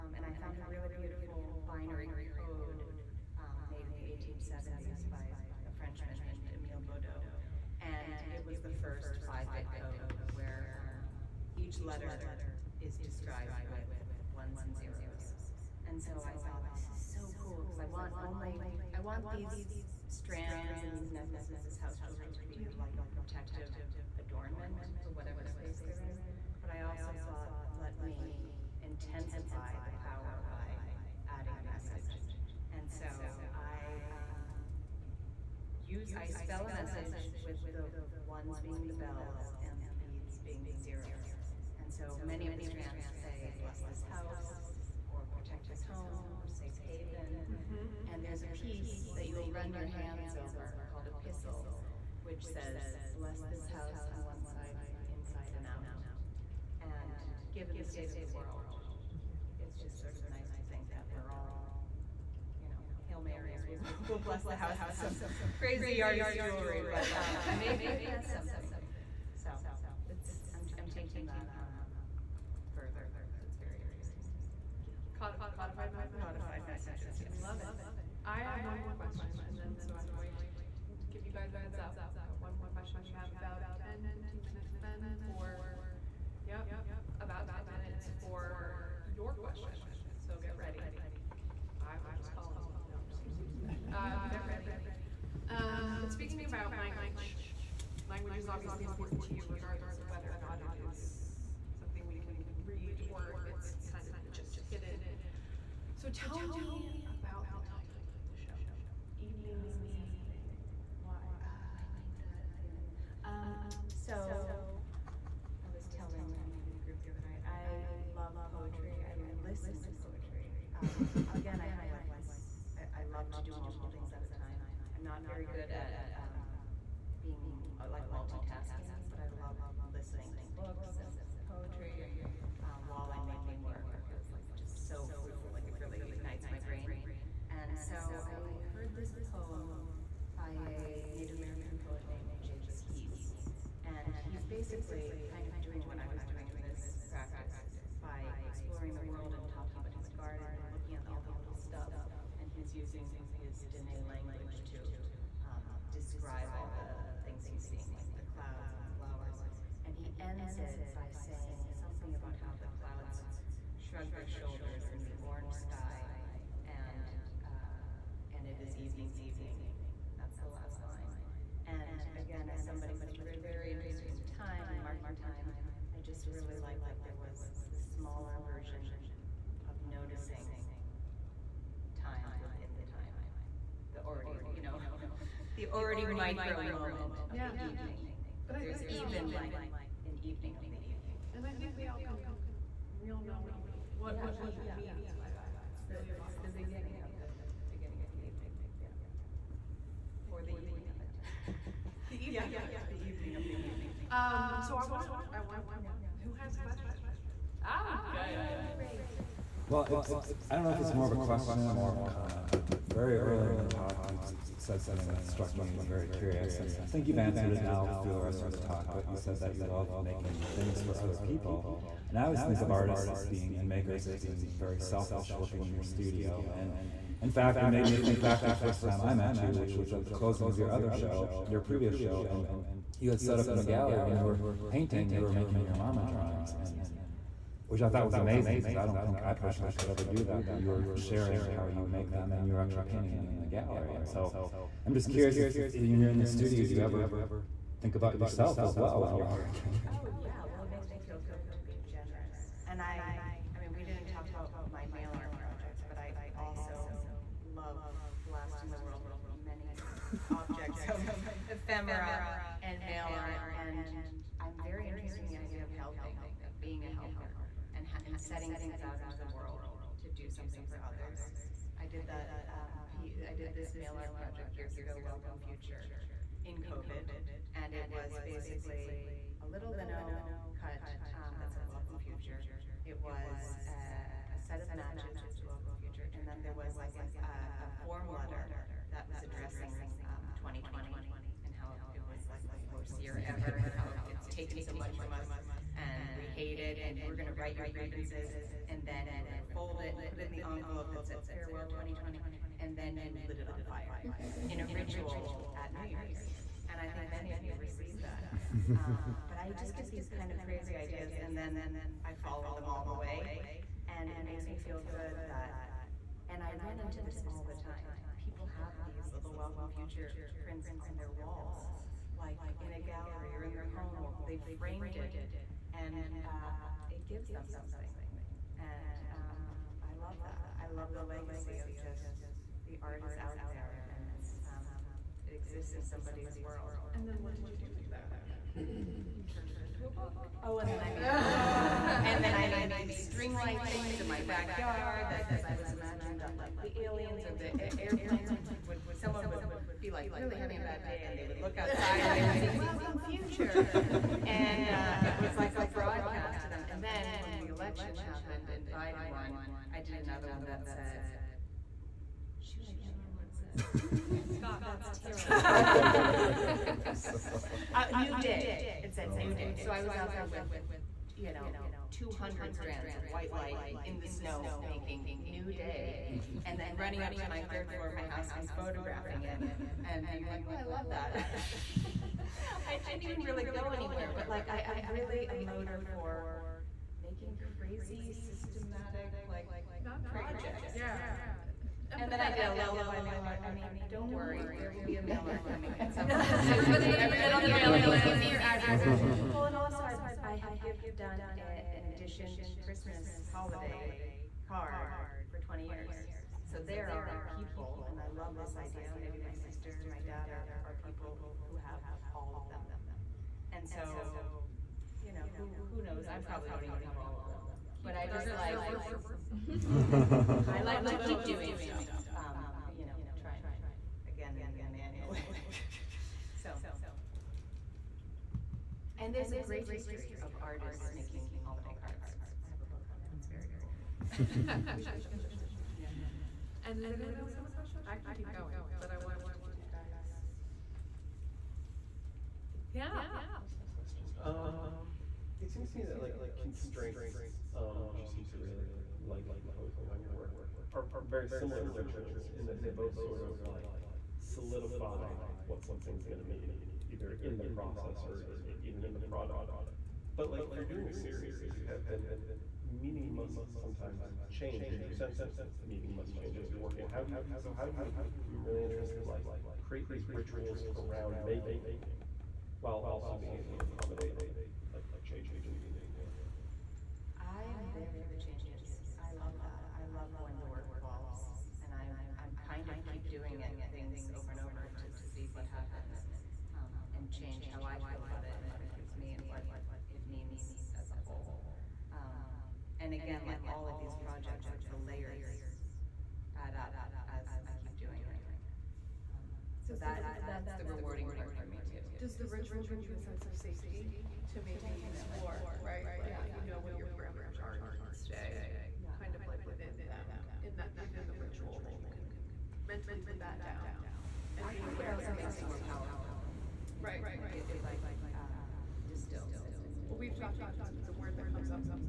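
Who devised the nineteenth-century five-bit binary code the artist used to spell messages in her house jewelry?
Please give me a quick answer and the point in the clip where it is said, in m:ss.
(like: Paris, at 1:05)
Emile Baudot, at 0:06.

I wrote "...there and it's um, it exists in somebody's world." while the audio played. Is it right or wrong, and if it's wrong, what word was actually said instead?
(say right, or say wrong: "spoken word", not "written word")
right.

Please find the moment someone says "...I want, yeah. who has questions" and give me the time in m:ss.
3:25.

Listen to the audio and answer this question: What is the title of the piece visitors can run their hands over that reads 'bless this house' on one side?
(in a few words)
Epistle.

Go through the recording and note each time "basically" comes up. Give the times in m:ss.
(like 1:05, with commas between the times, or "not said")
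2:24, 4:38.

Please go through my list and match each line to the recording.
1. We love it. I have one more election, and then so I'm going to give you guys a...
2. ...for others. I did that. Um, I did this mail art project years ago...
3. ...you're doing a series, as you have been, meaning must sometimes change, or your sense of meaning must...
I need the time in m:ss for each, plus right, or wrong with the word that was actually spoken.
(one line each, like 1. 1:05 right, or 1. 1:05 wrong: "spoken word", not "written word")
1. 1:17 wrong: "question", not "election"
2. 4:30 right
3. 7:40 right.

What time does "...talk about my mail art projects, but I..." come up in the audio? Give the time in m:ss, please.
4:14.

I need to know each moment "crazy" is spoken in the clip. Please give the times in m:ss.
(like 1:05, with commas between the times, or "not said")
1:05, 5:10, 6:27.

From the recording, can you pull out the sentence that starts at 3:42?
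And I always think of artists as being and makers as being very selfish, working in your studio.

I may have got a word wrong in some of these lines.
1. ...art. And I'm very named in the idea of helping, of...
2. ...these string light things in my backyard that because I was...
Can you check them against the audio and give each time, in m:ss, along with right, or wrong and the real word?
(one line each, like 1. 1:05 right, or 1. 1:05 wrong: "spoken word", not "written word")
1. 4:23 wrong: "interested", not "named"
2. 5:42 right.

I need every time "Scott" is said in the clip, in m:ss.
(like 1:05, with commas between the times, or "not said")
6:04.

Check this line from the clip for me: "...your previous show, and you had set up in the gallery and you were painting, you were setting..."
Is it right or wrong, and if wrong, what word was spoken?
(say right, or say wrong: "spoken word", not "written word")
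wrong: "making", not "setting".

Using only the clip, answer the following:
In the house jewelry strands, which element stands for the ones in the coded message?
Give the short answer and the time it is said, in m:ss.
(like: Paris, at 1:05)
the bells, at 0:38.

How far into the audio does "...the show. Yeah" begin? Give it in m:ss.
7:15.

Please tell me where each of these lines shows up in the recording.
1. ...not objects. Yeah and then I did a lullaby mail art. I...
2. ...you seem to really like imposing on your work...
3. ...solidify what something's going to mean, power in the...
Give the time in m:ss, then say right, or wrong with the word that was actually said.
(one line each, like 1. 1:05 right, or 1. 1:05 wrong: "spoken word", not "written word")
1. 6:29 wrong: "projects", not "objects"
2. 7:28 right
3. 7:34 wrong: "either", not "power".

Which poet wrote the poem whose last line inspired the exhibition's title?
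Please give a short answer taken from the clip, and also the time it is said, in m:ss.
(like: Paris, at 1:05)
Jake Skeets, at 2:22.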